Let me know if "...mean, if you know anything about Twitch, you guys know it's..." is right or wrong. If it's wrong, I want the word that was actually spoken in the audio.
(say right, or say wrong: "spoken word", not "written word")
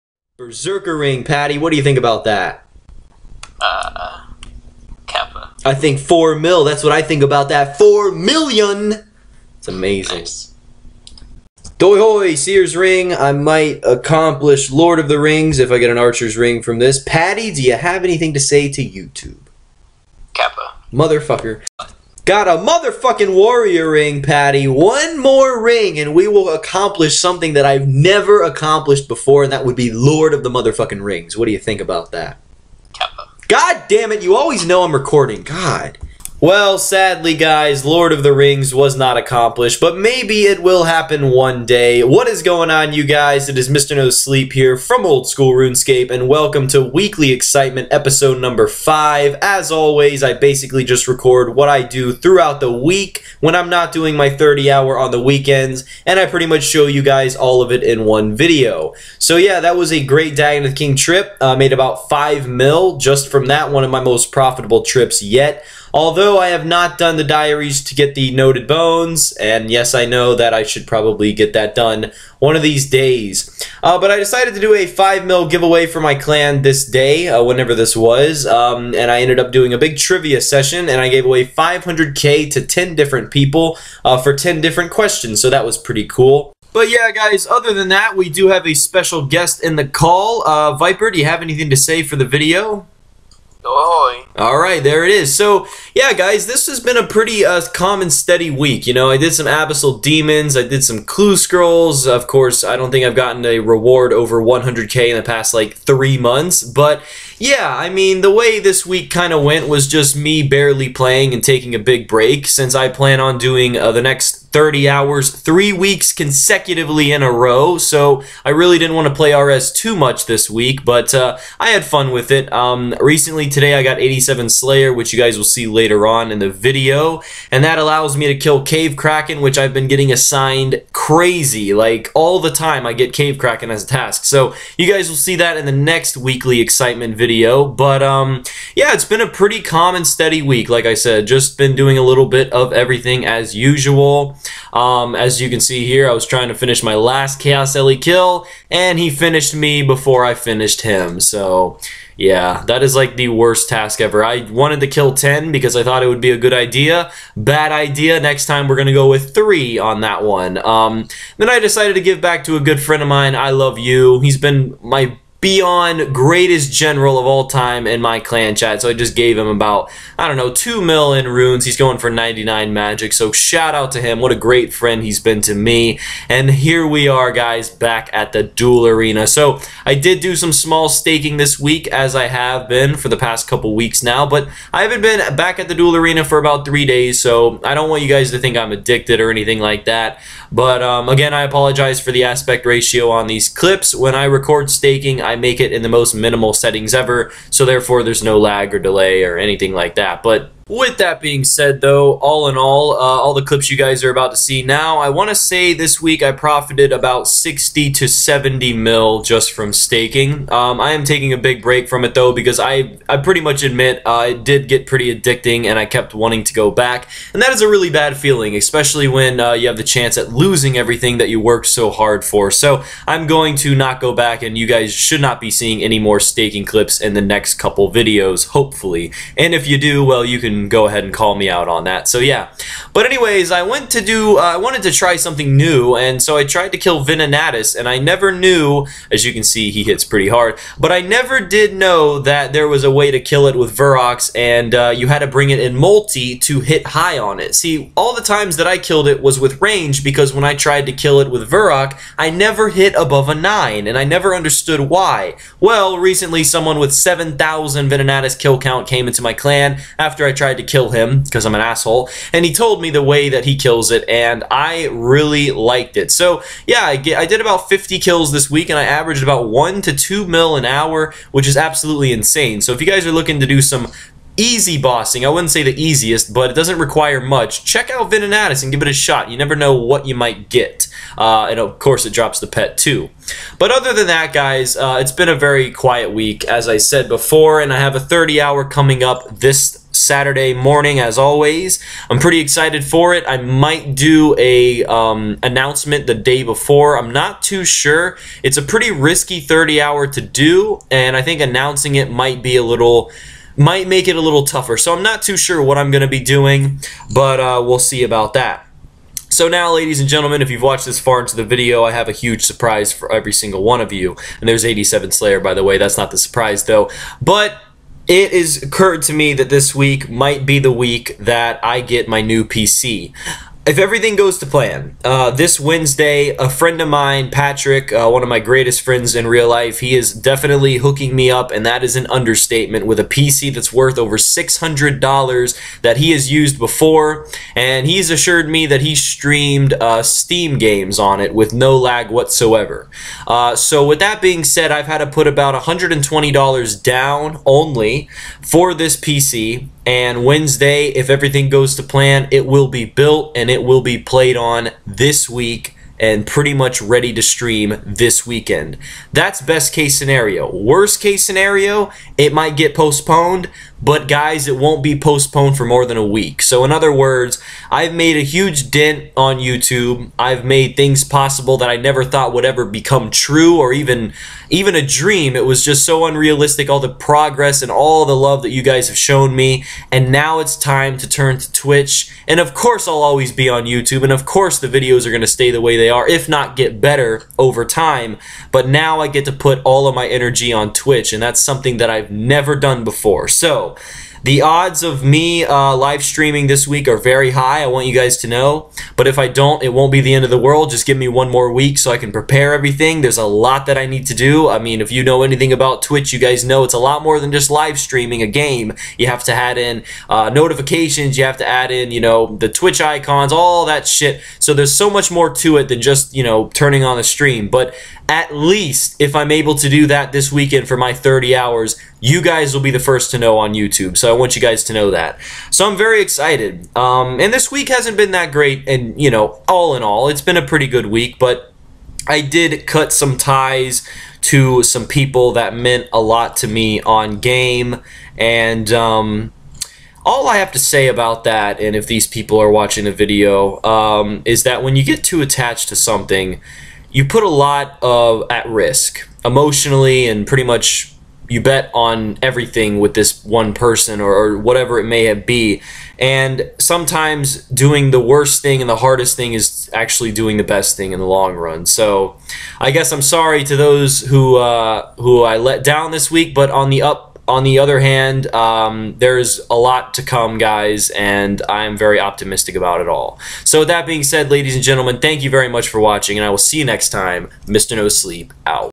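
right.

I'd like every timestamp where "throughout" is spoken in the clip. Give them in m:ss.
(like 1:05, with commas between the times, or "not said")
0:52.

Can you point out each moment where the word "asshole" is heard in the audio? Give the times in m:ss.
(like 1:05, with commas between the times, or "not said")
4:21.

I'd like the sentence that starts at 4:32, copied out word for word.
So if you guys are looking to do some easy bossing.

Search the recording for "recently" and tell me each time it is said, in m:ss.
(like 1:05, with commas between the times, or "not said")
2:02, 4:15.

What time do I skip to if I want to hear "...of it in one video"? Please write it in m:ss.
0:57.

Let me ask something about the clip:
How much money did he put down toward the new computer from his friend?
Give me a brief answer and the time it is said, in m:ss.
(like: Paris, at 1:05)
$120, at 5:45.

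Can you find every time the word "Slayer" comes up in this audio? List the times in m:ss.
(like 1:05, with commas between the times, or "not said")
2:04, 5:15.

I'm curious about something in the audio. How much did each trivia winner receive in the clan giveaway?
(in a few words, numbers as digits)
500k.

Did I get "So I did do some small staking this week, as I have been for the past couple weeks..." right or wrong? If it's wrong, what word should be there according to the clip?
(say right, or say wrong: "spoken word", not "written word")
right.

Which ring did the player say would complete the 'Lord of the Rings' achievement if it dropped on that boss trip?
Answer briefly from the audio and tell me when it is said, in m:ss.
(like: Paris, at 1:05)
Archer's Ring, at 0:15.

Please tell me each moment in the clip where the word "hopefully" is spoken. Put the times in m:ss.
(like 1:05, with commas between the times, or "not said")
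3:48.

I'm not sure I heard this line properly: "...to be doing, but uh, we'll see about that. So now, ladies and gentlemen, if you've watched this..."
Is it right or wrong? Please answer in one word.
right.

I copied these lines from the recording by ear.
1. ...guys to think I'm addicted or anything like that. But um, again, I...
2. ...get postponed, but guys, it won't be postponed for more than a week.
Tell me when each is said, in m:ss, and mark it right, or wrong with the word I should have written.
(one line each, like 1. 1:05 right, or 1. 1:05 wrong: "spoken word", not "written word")
1. 3:08 right
2. 6:02 right.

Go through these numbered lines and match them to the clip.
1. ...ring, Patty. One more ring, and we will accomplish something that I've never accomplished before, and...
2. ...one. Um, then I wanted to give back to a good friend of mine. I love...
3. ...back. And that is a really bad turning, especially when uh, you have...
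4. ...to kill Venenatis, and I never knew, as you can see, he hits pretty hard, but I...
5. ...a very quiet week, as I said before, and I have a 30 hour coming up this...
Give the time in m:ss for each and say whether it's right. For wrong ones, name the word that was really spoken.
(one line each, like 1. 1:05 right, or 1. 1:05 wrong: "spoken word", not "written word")
1. 0:23 right
2. 2:40 wrong: "decided", not "wanted"
3. 3:36 wrong: "feeling", not "turning"
4. 3:56 right
5. 4:45 right.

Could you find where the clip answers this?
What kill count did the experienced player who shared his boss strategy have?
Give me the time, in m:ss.
4:16.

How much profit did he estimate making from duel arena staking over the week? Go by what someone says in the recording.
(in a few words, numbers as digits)
60 to 70 mil.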